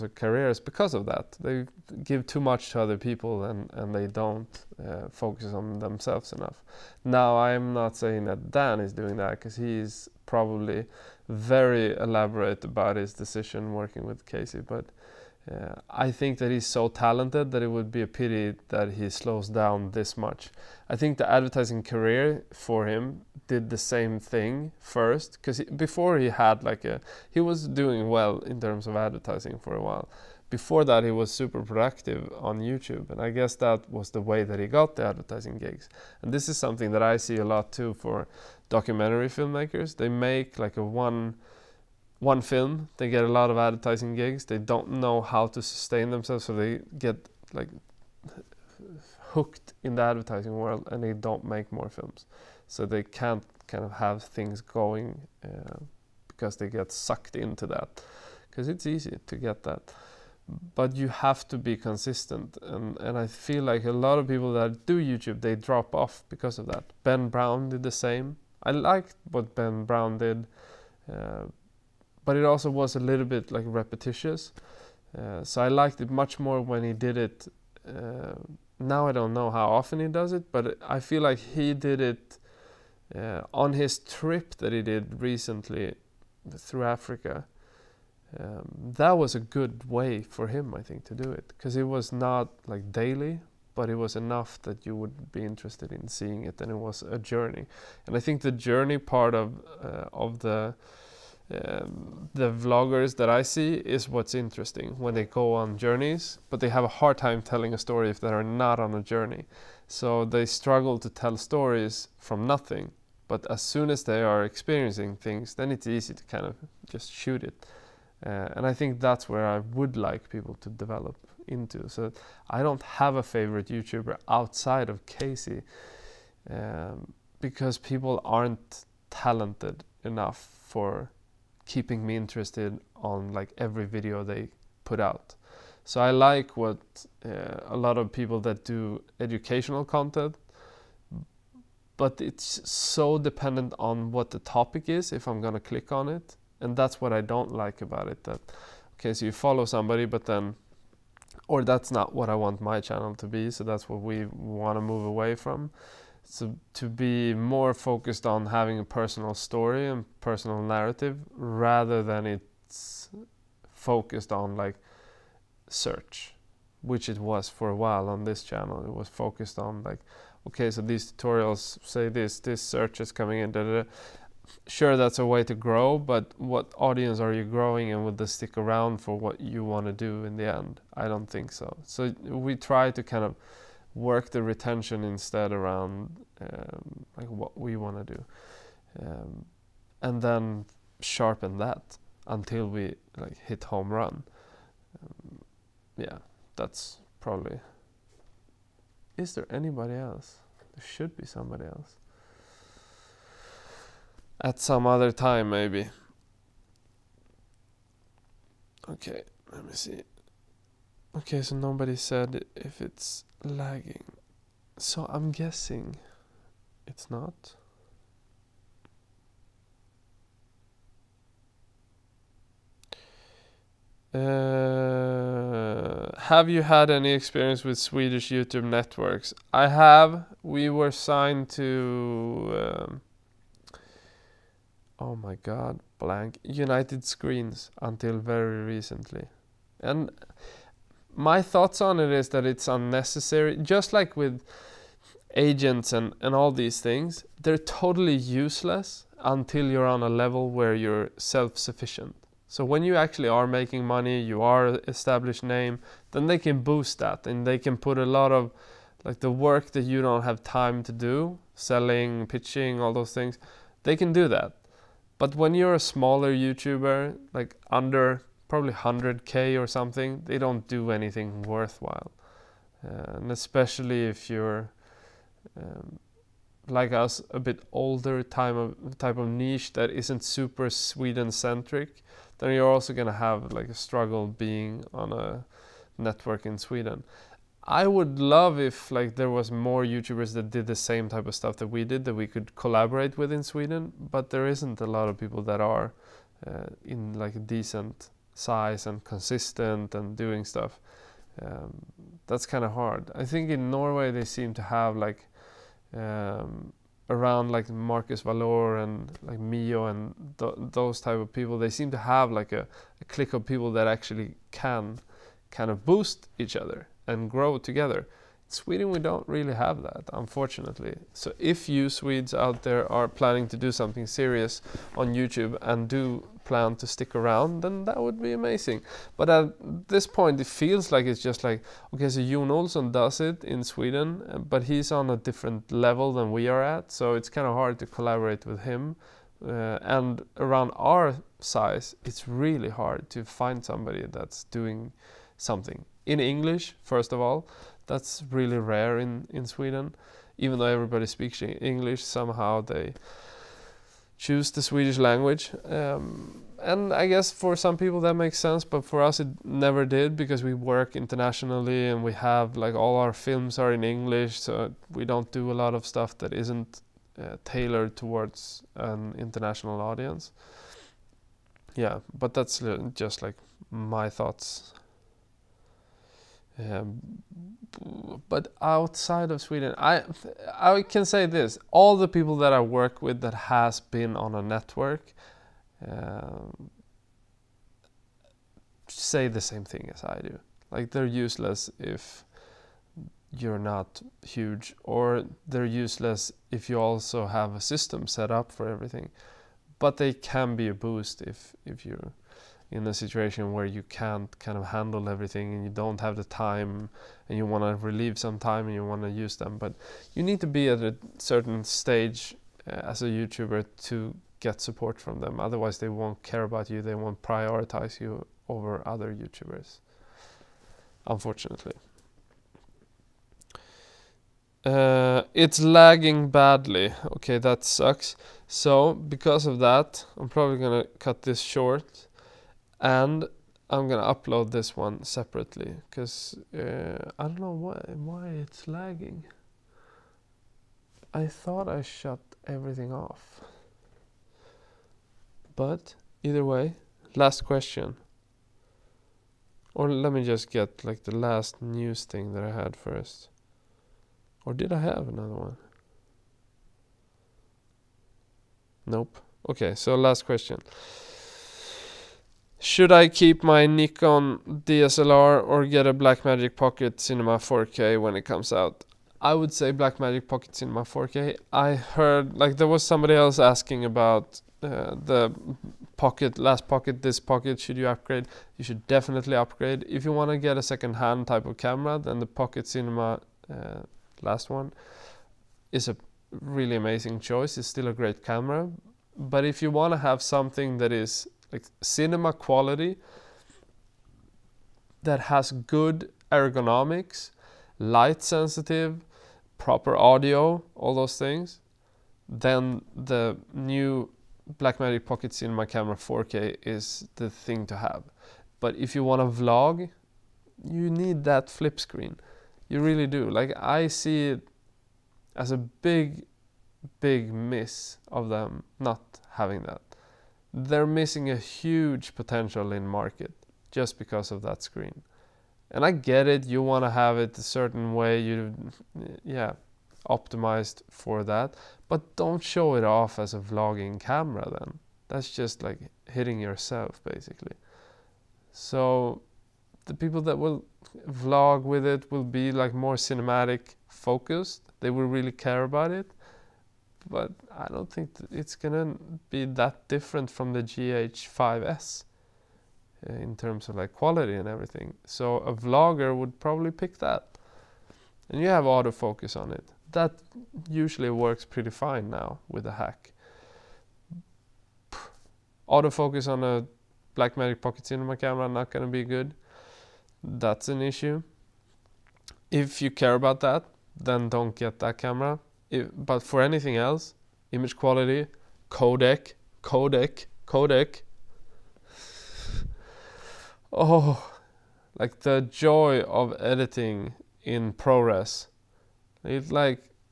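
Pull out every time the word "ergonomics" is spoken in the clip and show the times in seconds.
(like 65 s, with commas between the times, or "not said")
496 s.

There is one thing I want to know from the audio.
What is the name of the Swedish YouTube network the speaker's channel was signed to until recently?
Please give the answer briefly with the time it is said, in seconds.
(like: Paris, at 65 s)
United Screens, at 236 s.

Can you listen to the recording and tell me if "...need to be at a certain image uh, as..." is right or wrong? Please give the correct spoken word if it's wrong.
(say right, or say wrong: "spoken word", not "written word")
wrong: "stage", not "image".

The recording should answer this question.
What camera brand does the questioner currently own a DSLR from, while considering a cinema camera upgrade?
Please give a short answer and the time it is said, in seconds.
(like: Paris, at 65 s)
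Nikon, at 463 s.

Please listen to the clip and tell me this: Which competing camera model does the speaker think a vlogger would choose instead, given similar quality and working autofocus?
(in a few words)
GH5S.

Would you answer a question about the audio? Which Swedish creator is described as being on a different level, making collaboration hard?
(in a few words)
Jon Olsson.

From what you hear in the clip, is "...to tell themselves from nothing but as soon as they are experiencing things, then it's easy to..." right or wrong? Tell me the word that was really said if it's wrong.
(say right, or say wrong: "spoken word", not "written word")
wrong: "stories", not "themselves".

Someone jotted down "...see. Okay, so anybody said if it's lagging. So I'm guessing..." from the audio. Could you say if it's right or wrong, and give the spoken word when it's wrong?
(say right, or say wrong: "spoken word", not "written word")
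wrong: "nobody", not "anybody".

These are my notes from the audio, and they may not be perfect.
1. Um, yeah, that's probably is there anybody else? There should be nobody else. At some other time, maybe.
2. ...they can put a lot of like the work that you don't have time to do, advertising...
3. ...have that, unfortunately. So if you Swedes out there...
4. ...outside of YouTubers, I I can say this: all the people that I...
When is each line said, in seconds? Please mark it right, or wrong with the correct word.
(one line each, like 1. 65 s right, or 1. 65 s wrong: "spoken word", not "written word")
1. 195 s wrong: "somebody", not "nobody"
2. 257 s wrong: "selling", not "advertising"
3. 319 s right
4. 378 s wrong: "Sweden", not "YouTubers".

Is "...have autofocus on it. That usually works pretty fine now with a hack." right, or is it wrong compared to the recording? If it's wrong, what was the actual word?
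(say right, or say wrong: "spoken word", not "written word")
right.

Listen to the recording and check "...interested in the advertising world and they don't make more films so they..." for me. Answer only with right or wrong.
wrong.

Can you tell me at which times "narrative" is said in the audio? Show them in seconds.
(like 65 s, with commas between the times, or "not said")
160 s.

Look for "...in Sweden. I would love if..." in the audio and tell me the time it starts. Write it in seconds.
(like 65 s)
286 s.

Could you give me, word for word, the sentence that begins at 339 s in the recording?
Uh, and around our size, it's really hard to find somebody that's doing something in English, first of all.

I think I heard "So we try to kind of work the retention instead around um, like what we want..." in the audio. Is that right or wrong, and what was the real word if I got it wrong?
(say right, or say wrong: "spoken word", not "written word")
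right.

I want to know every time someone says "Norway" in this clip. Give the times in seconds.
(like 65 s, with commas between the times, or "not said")
303 s.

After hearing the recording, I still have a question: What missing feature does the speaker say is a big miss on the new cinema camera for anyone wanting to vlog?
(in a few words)
flip screen.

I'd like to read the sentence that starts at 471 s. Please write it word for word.
I heard like there was somebody else asking about uh, the pocket, last pocket, this pocket.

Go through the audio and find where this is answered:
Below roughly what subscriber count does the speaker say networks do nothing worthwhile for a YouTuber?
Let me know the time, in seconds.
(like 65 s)
268 s.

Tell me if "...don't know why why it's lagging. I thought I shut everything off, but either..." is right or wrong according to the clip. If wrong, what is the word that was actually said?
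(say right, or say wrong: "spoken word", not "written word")
right.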